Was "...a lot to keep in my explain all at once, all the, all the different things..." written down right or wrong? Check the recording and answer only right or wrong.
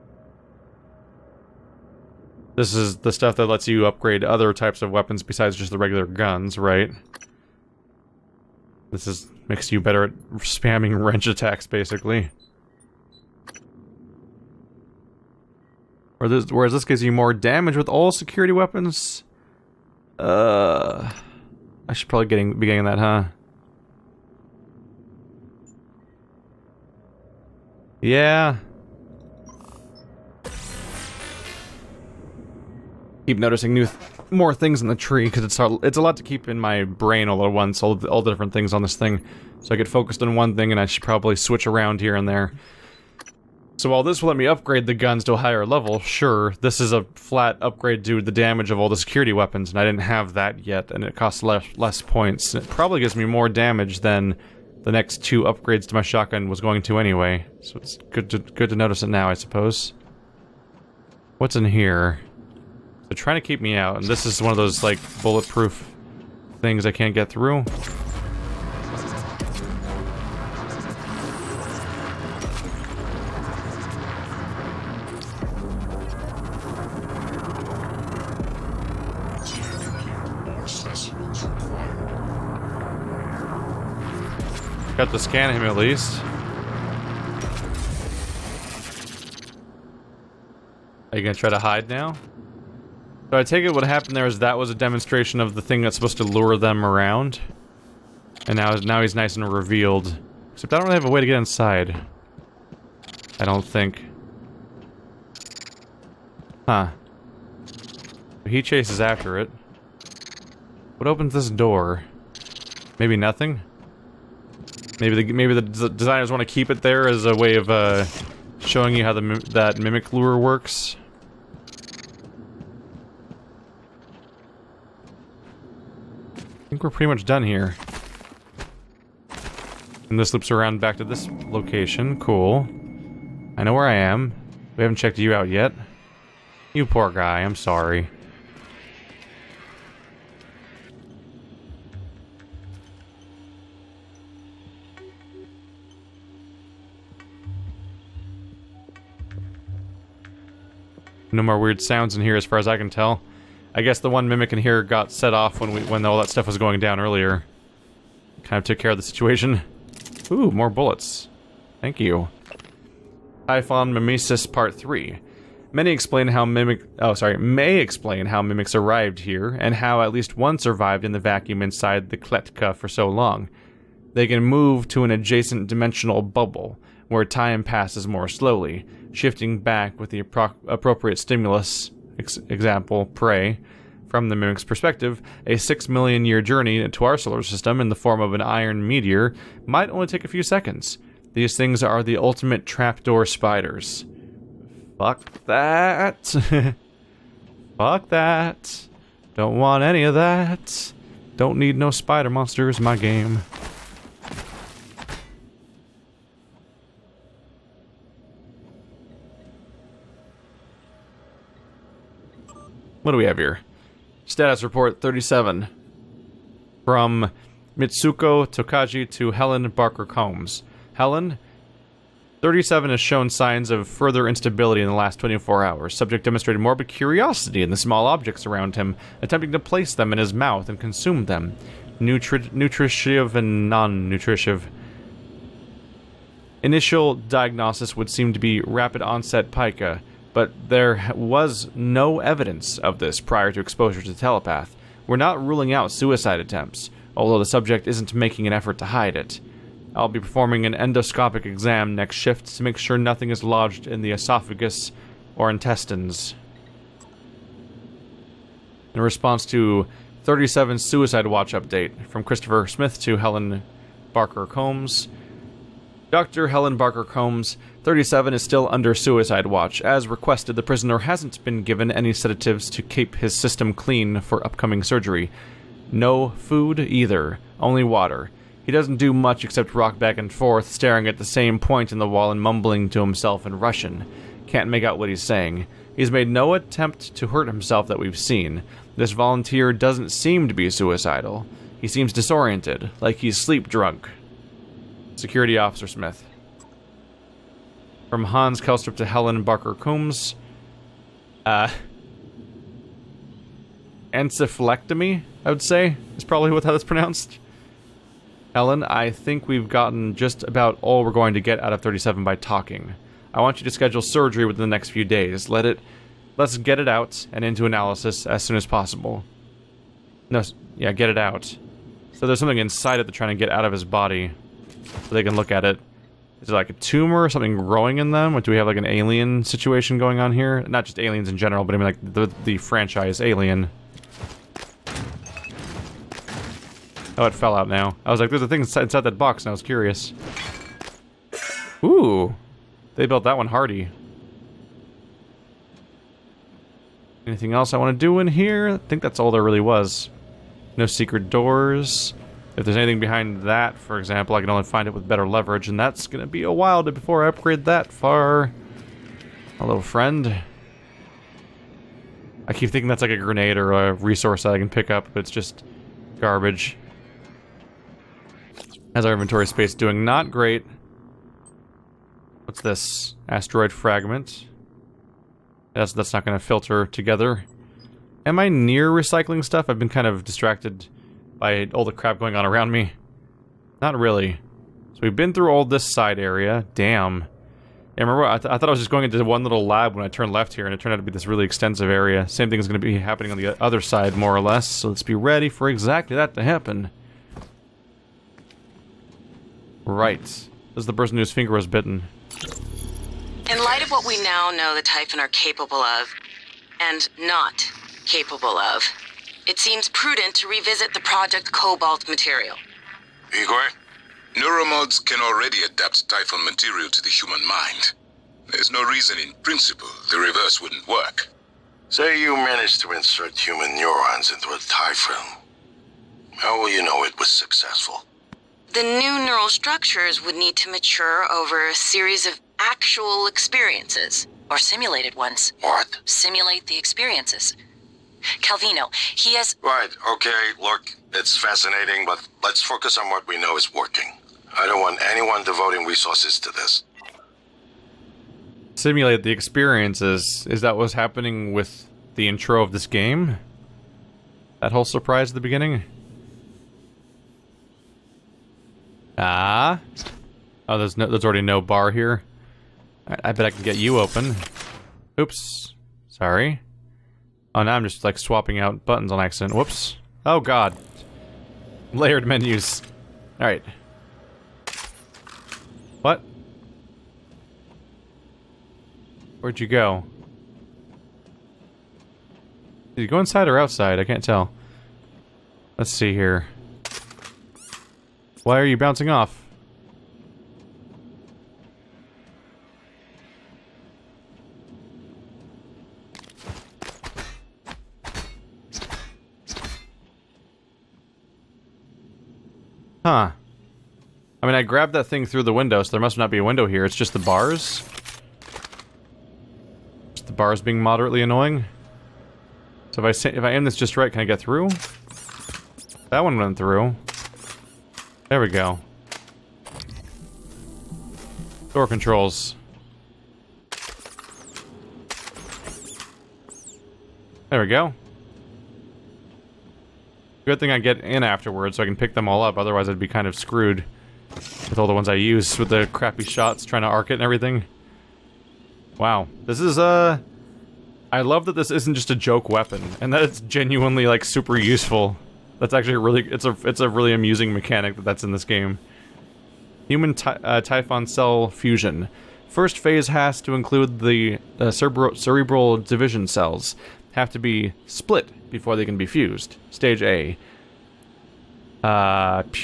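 wrong.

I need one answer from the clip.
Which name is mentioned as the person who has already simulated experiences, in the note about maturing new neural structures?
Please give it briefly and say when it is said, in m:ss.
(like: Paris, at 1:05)
Calvino, at 7:18.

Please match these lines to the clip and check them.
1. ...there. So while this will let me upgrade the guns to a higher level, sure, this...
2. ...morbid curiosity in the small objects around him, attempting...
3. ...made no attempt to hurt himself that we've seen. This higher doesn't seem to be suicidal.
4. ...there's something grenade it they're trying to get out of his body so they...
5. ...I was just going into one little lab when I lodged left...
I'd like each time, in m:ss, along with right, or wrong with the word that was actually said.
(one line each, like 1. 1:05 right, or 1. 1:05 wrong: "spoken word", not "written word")
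1. 0:42 right
2. 3:46 right
3. 4:46 wrong: "volunteer", not "higher"
4. 5:22 wrong: "inside", not "grenade"
5. 6:28 wrong: "turned", not "lodged".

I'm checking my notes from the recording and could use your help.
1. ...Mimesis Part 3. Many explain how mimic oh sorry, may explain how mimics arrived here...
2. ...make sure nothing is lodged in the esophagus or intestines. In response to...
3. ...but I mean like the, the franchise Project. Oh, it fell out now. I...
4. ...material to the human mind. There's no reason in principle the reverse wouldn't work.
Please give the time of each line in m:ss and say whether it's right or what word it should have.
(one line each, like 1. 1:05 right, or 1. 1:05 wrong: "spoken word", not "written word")
1. 2:43 right
2. 4:12 right
3. 5:31 wrong: "Alien", not "Project"
4. 6:56 right.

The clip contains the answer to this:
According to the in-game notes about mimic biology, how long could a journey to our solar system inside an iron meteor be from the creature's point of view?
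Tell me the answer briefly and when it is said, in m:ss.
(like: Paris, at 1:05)
6 million years, at 3:05.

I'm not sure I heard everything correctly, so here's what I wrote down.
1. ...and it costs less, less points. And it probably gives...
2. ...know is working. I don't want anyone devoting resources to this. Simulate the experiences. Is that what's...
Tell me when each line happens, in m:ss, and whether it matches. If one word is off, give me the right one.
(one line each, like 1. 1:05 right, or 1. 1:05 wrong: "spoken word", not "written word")
1. 0:50 right
2. 7:23 right.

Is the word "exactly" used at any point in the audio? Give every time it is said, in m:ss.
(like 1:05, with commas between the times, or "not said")
6:35.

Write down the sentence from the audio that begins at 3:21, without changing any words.
Don't need no spider monsters in my game.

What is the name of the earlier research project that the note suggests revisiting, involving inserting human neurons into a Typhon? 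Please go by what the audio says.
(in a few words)
Project Cobalt.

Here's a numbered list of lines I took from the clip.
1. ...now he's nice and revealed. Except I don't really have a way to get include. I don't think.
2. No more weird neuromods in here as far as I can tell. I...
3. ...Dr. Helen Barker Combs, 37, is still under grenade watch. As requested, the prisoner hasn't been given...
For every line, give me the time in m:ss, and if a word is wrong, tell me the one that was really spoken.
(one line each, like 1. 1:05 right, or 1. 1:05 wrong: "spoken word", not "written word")
1. 1:38 wrong: "inside", not "include"
2. 2:31 wrong: "sounds", not "neuromods"
3. 4:26 wrong: "suicide", not "grenade".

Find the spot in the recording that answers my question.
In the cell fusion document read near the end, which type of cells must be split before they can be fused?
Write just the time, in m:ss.
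9:14.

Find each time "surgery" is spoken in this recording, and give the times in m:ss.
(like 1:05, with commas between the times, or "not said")
4:34, 5:14.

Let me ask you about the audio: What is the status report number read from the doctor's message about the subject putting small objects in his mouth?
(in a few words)
37.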